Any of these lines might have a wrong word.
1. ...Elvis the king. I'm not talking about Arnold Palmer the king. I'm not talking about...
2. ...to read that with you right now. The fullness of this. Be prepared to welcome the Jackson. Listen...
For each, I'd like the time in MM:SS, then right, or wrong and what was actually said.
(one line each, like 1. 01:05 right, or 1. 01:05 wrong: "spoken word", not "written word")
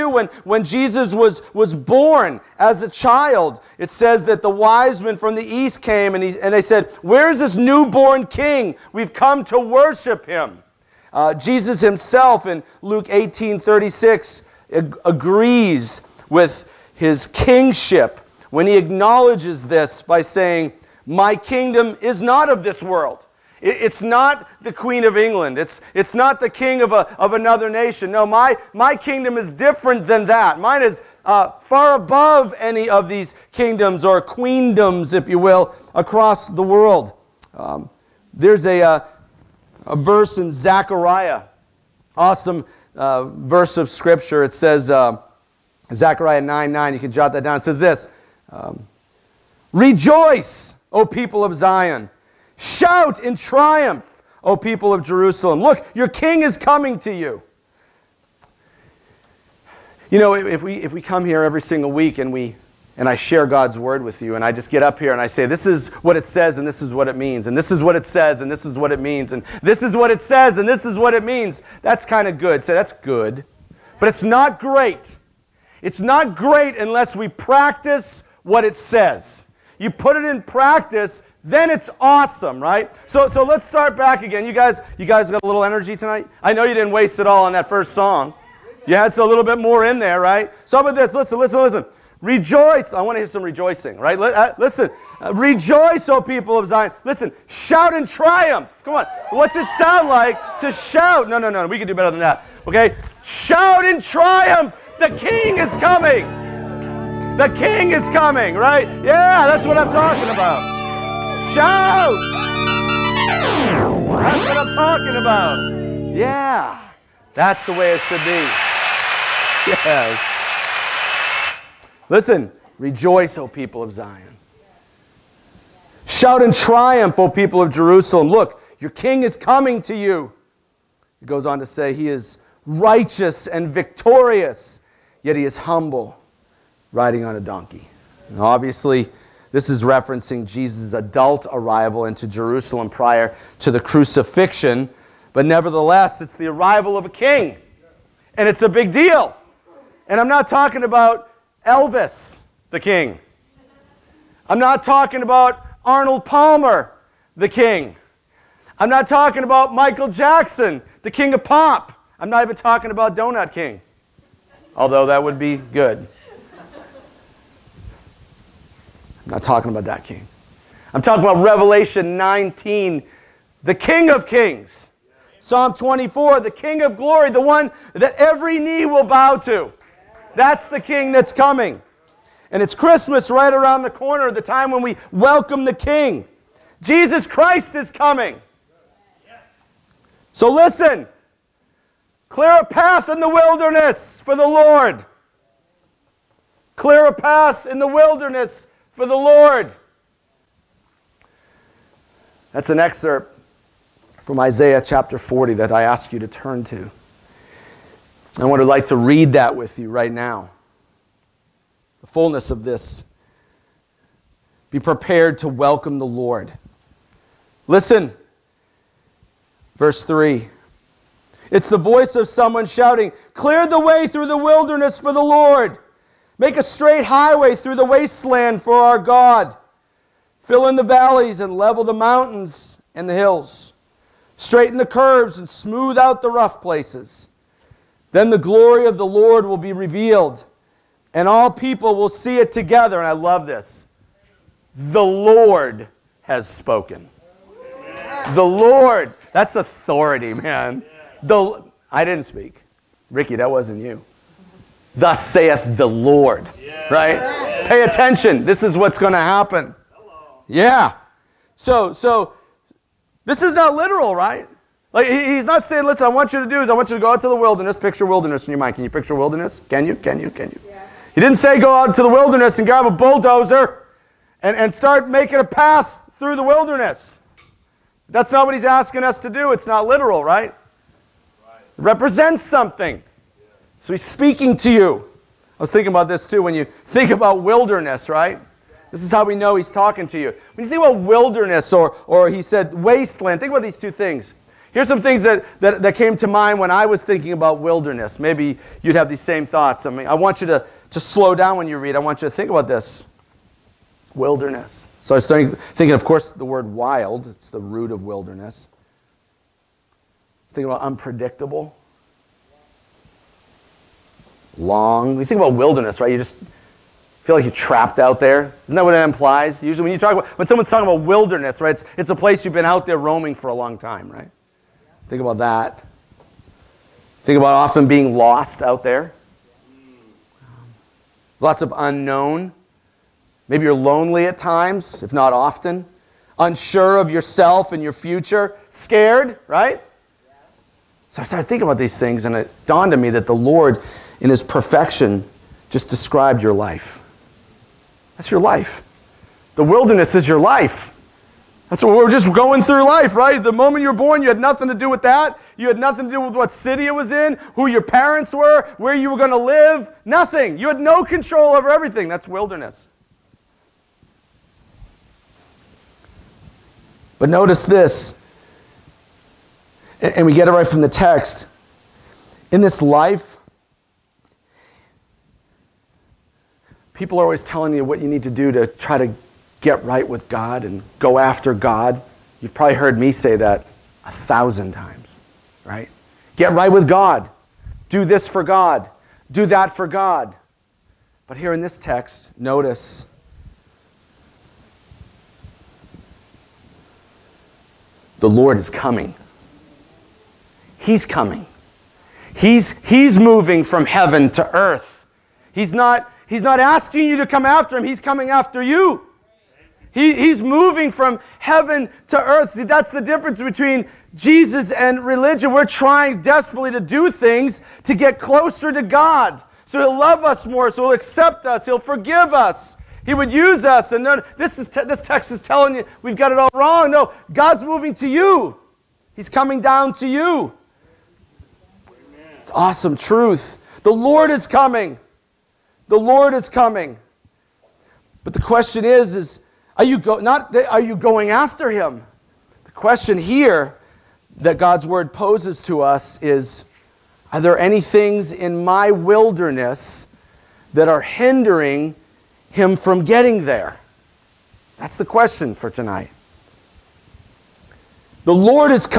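1. 02:31 right
2. 03:28 wrong: "Lord", not "Jackson".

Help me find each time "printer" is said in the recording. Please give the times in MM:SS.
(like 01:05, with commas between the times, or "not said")
not said.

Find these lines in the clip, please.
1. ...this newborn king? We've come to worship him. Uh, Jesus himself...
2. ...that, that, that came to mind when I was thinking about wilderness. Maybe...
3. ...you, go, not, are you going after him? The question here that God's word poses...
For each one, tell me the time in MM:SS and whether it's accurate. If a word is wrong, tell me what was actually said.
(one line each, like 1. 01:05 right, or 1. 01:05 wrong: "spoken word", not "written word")
1. 00:07 right
2. 04:55 right
3. 07:19 right.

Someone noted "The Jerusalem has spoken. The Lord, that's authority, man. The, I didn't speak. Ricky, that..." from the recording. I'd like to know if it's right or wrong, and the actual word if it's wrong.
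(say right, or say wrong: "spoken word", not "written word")
wrong: "Lord", not "Jerusalem".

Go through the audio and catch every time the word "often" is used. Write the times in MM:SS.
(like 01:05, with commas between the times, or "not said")
05:27, 05:35.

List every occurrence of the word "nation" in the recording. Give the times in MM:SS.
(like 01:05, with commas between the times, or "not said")
00:27.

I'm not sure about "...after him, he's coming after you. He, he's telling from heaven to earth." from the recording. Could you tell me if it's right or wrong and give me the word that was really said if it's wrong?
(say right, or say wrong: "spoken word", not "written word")
wrong: "moving", not "telling".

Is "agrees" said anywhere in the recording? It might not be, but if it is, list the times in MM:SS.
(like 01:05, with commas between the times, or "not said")
00:15.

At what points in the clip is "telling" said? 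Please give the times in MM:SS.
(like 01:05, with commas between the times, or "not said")
06:17, 07:05.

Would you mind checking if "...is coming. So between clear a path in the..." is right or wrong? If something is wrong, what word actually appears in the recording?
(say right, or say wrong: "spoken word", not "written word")
wrong: "listen", not "between".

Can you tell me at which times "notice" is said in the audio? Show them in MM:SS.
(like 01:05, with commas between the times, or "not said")
06:07, 06:32.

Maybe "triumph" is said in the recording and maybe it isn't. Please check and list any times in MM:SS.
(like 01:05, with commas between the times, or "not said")
00:53, 01:38, 01:43, 02:06.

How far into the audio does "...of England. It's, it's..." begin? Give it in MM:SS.
00:25.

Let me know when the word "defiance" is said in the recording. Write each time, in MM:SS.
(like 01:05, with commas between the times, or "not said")
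not said.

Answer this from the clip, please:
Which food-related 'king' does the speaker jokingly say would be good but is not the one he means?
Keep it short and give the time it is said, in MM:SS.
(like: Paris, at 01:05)
Donut King, at 02:43.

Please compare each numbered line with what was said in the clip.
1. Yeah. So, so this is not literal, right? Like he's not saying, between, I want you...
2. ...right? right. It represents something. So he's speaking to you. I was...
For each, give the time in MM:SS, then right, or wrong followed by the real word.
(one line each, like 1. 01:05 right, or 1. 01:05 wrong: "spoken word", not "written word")
1. 04:20 wrong: "listen", not "between"
2. 04:40 right.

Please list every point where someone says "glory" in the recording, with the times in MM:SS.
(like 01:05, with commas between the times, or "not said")
02:56, 03:58.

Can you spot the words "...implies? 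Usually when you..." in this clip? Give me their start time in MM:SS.
05:18.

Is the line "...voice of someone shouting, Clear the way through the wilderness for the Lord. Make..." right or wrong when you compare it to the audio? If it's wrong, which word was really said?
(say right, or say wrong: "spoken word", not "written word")
right.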